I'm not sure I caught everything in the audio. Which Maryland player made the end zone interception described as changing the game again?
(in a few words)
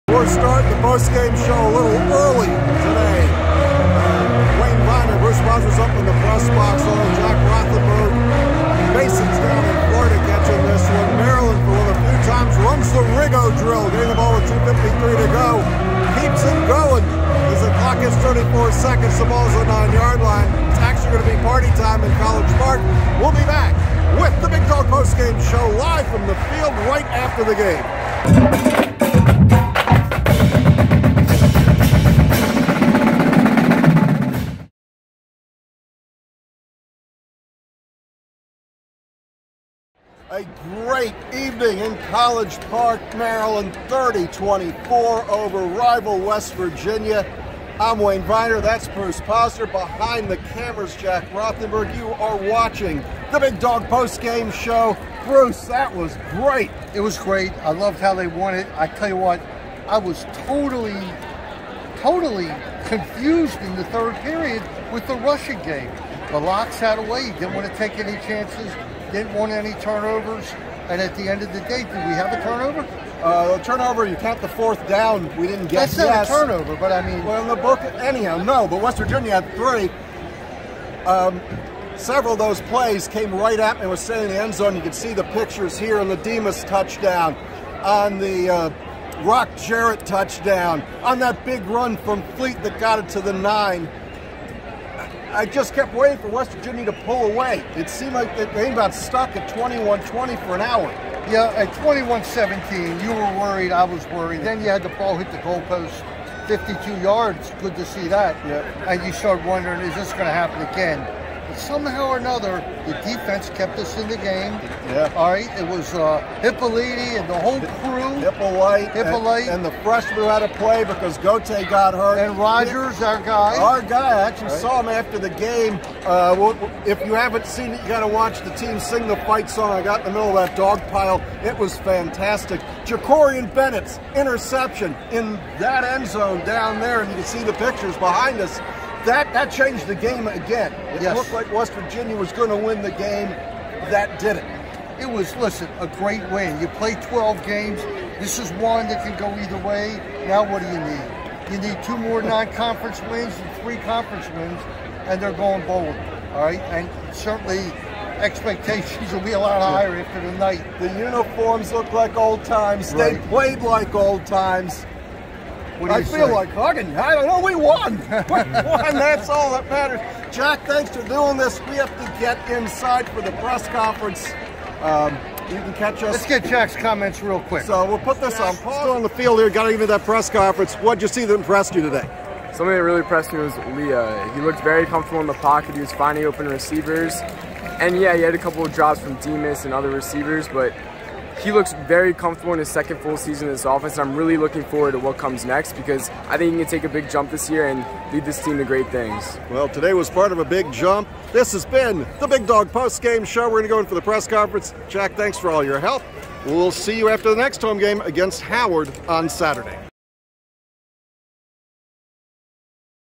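Jakorian Bennett.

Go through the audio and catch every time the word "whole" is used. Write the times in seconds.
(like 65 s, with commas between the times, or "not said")
117 s.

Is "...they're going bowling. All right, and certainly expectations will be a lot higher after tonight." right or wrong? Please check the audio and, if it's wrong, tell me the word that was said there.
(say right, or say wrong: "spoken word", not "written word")
right.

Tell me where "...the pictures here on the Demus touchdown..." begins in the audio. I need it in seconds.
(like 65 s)
85 s.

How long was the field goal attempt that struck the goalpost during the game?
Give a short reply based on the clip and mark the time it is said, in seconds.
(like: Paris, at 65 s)
52 yards, at 106 s.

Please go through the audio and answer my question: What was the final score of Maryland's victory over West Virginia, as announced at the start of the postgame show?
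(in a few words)
30-24.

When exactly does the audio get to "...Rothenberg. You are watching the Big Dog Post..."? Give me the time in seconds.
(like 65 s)
51 s.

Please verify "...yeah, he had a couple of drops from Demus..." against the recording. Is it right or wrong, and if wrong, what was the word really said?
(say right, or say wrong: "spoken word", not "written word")
right.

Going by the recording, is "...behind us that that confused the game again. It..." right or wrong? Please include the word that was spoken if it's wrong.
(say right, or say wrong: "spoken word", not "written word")
wrong: "changed", not "confused".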